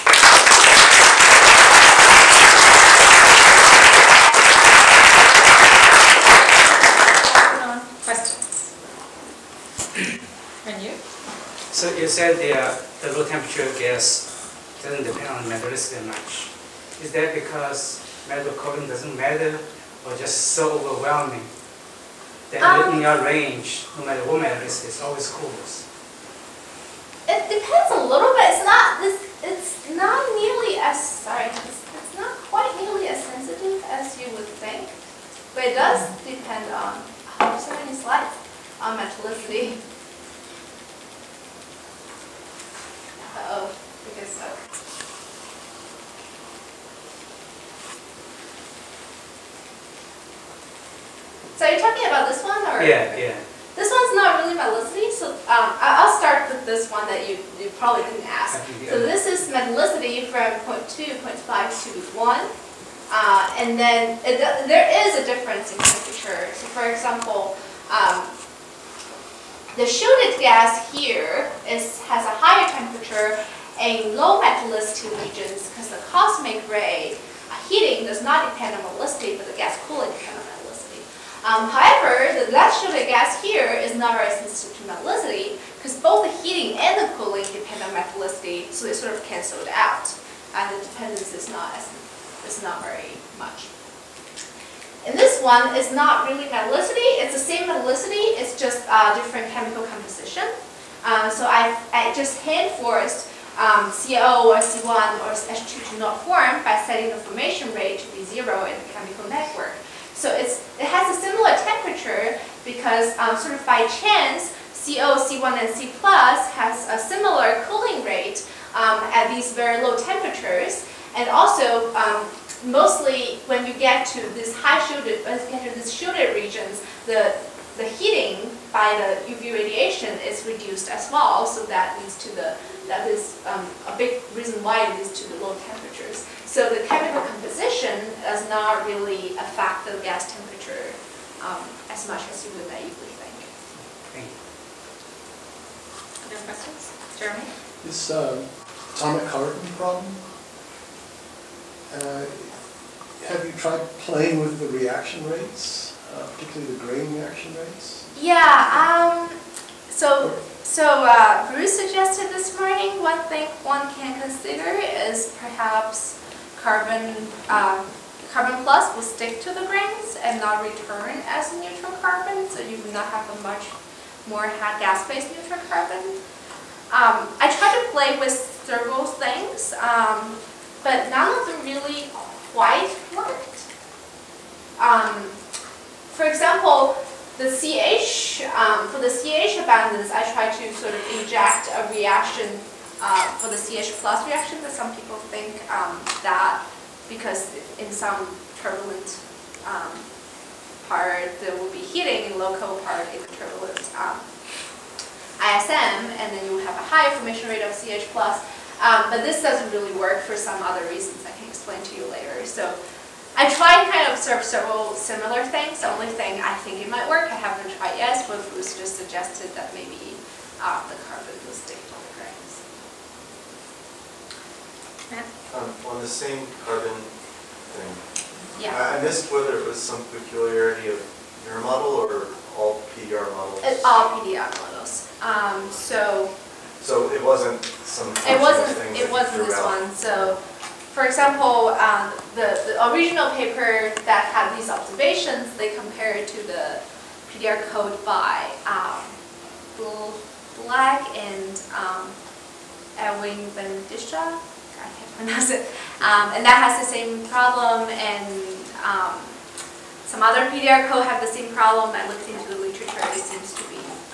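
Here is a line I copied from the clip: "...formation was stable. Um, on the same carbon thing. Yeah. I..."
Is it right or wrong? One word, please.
wrong.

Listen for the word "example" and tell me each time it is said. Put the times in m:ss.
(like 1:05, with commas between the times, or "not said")
1:06, 3:06, 4:01.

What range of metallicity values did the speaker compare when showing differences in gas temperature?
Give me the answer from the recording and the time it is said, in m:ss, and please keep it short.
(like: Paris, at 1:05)
0.5 to 1, at 1:00.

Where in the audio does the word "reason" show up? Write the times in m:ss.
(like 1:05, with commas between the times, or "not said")
2:14, 3:30.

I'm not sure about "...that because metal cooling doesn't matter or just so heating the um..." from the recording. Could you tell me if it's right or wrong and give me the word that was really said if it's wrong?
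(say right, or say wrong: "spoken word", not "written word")
wrong: "overwhelming", not "heating".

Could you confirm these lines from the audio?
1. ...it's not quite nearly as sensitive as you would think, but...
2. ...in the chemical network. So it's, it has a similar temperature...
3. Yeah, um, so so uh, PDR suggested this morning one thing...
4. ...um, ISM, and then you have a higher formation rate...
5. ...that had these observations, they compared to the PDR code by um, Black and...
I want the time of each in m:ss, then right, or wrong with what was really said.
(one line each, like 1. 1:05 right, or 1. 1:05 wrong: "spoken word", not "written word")
1. 0:31 right
2. 1:48 right
3. 2:38 wrong: "Bruce", not "PDR"
4. 3:23 right
5. 4:04 right.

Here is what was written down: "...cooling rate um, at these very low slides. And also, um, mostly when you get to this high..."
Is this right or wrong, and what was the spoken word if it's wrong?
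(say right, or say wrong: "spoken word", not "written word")
wrong: "temperatures", not "slides".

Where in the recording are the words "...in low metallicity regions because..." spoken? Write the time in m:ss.
1:13.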